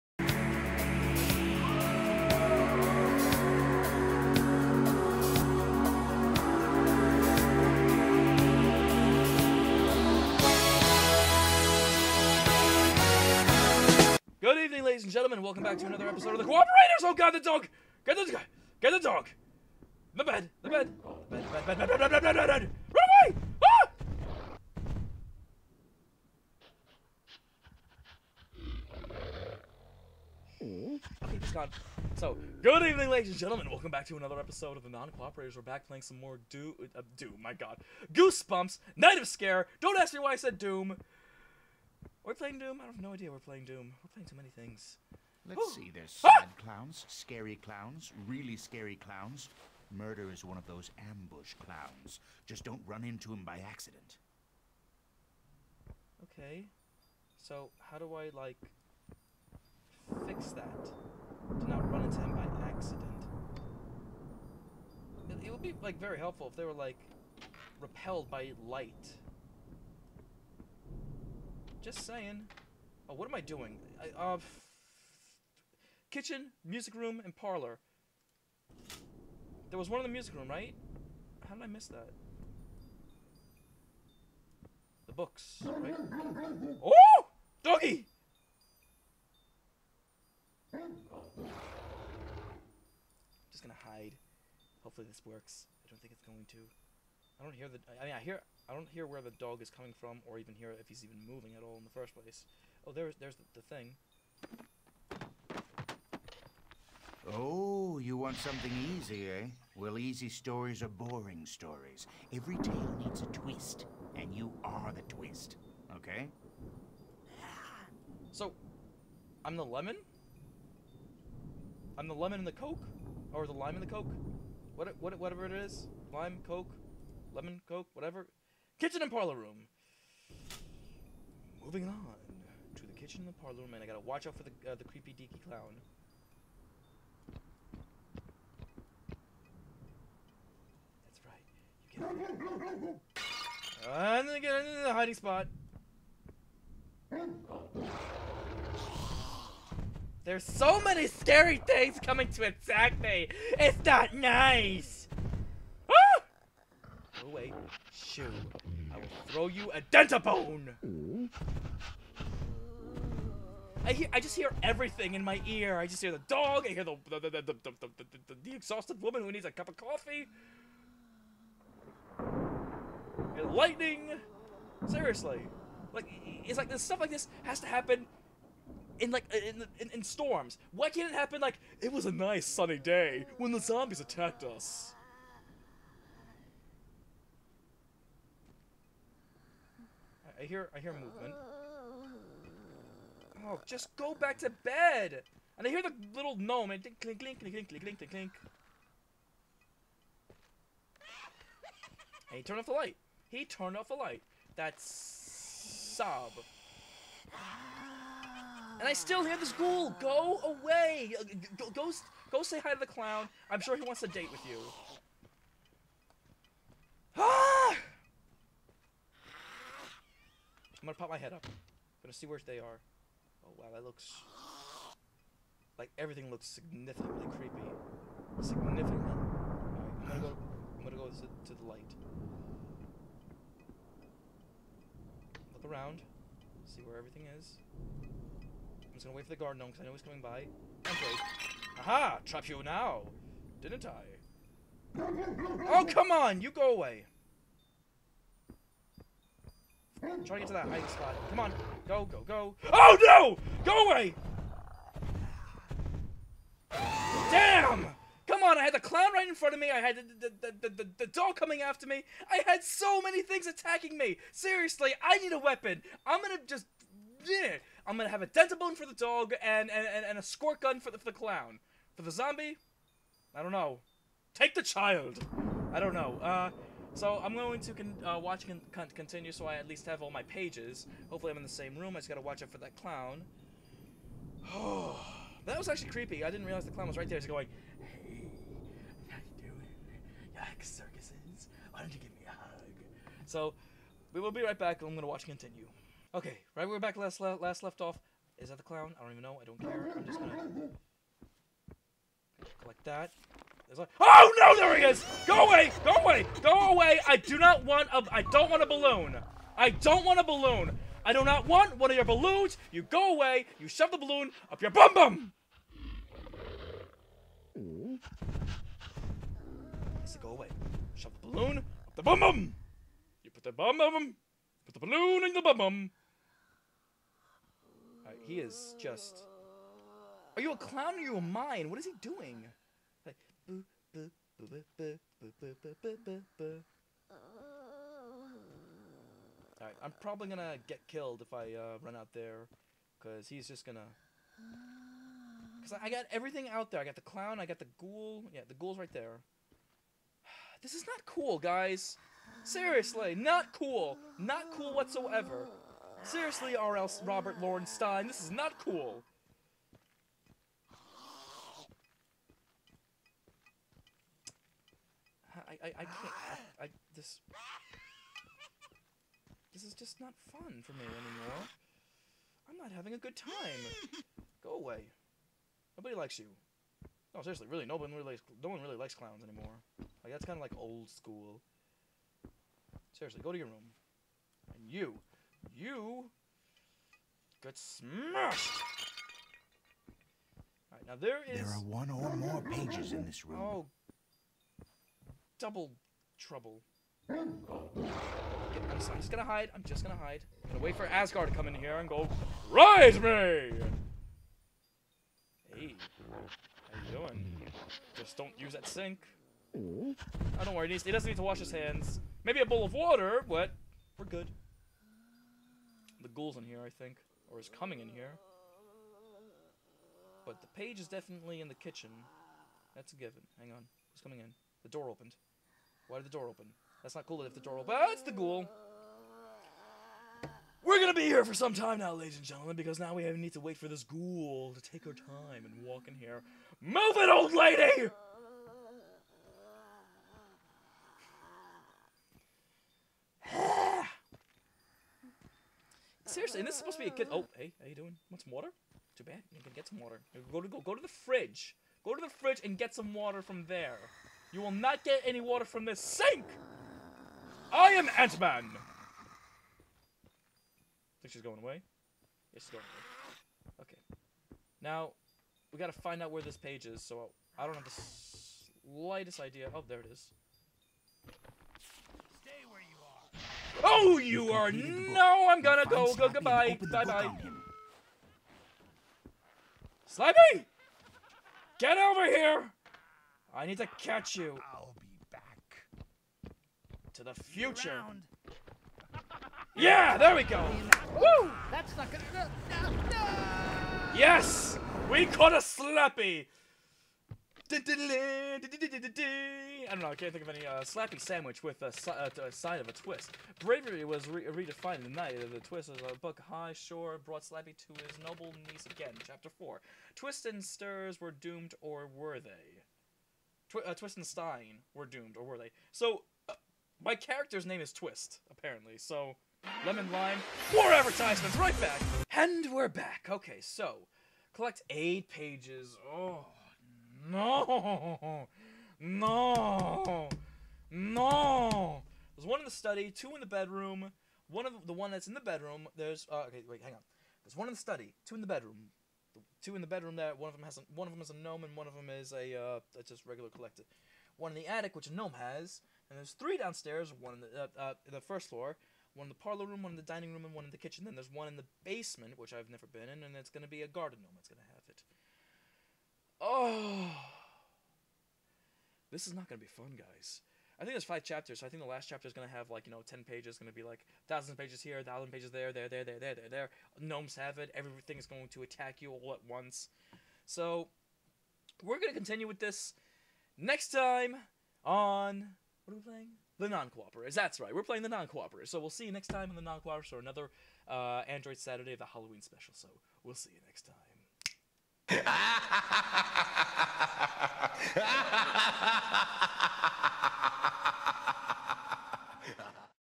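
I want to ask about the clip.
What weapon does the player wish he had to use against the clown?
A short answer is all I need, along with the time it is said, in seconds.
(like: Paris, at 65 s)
A squirt gun, at 270 s.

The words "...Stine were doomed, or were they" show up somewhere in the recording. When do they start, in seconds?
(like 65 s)
514 s.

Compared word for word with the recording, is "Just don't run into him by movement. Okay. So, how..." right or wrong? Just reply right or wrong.
wrong.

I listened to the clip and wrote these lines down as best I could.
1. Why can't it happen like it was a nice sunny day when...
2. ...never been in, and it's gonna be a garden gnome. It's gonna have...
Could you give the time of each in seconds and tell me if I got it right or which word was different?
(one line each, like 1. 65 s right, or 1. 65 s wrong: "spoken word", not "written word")
1. 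180 s right
2. 552 s right.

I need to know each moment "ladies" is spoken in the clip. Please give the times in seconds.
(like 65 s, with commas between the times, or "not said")
14 s, 33 s, 431 s.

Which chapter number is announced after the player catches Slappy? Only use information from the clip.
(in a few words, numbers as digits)
4.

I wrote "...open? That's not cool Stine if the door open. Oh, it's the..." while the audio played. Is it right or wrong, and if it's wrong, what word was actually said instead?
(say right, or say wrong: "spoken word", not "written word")
wrong: "That", not "Stine".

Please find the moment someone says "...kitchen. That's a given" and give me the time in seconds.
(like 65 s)
421 s.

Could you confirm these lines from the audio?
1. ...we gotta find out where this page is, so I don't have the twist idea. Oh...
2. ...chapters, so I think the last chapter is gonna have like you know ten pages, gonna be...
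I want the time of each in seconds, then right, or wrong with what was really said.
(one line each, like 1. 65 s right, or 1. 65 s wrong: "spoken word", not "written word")
1. 465 s wrong: "slightest", not "twist"
2. 561 s right.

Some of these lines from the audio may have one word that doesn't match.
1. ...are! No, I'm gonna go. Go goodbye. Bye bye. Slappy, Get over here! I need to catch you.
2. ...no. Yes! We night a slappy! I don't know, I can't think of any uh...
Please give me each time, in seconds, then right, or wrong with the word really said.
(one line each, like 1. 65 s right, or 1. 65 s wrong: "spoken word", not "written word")
1. 474 s right
2. 492 s wrong: "caught", not "night".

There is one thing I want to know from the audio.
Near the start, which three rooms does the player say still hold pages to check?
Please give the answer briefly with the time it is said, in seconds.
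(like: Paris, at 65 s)
Kitchen, music room, and parlor, at 76 s.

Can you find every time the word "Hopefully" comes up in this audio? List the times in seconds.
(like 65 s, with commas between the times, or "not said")
94 s, 281 s.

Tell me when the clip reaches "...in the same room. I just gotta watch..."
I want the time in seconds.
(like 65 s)
281 s.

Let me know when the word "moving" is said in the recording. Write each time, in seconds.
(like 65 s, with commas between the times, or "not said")
101 s, 131 s.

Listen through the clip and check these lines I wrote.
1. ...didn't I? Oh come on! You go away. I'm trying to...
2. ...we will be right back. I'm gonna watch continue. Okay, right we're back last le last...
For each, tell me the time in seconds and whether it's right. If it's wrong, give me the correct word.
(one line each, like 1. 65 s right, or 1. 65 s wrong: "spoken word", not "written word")
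1. 243 s right
2. 294 s right.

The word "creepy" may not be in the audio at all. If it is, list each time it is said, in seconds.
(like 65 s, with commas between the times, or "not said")
134 s, 227 s, 285 s.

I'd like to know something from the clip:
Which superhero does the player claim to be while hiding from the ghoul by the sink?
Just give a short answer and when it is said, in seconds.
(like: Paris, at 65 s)
Ant-Man, at 457 s.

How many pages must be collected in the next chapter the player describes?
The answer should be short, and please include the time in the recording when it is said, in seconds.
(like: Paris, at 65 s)
8, at 524 s.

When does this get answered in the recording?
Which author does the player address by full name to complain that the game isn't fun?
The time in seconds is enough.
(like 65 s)
357 s.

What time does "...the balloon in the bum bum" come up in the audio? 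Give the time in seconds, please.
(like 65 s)
324 s.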